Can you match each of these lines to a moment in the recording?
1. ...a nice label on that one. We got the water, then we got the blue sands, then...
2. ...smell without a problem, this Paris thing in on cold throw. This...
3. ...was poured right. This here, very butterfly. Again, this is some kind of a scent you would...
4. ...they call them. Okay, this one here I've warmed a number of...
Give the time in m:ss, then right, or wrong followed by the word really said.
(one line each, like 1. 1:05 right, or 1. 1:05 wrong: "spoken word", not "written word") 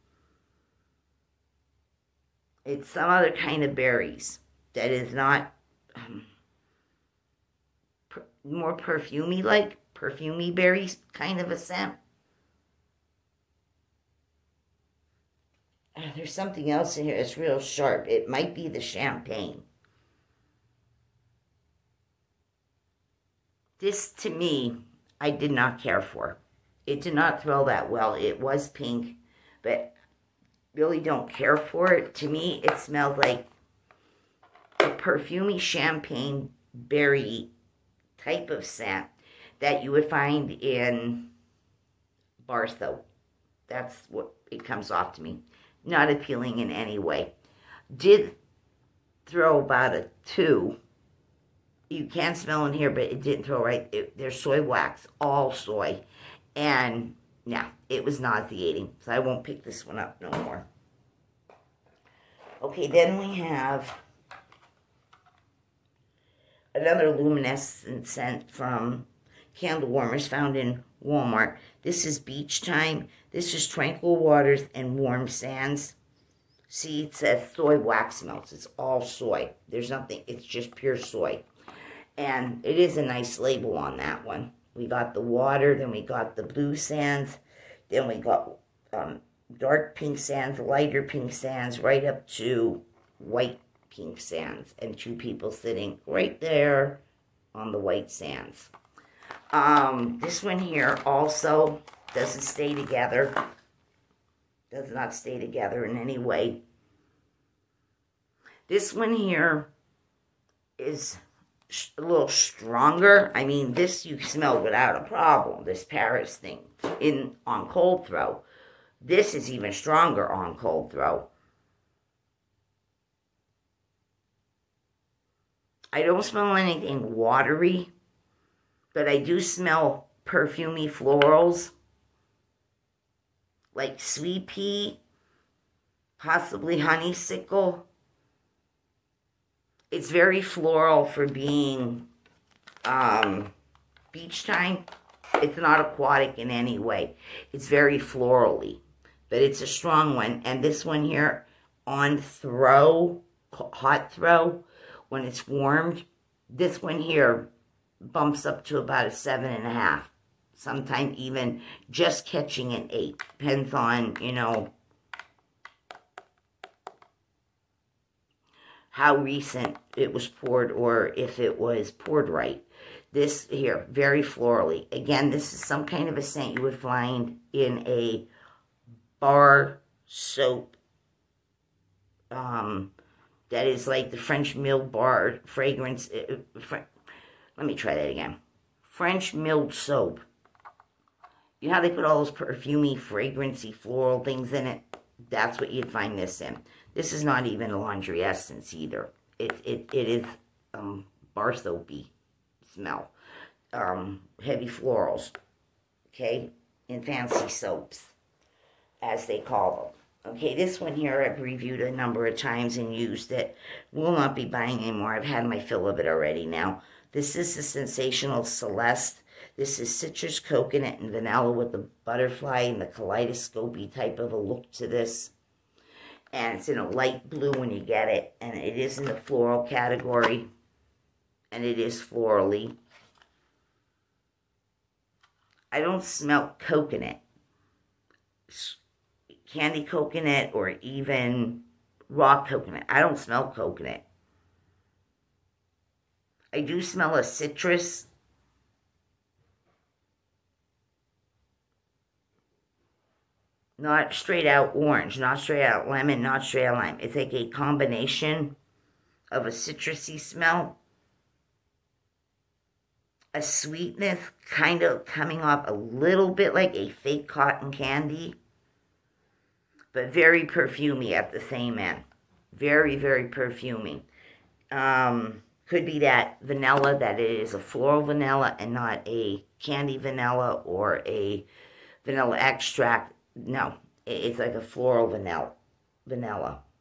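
1. 1:22 right
2. 1:54 right
3. 2:51 wrong: "florally", not "butterfly"
4. 3:29 wrong: "reviewed", not "warmed".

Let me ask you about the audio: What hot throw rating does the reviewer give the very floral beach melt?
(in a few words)
7.5.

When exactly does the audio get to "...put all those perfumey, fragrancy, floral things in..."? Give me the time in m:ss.
3:11.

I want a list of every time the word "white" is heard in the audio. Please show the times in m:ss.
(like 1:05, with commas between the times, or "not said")
1:33, 1:37.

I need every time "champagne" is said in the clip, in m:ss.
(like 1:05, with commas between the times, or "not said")
0:18, 0:35.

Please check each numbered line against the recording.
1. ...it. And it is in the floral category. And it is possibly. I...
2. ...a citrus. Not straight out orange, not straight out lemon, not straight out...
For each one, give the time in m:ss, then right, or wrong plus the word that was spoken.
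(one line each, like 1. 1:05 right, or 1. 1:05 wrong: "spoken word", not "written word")
1. 3:48 wrong: "florally", not "possibly"
2. 4:07 right.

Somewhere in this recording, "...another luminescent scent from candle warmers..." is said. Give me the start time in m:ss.
1:06.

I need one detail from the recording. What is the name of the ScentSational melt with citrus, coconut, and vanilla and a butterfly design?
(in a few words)
Celeste.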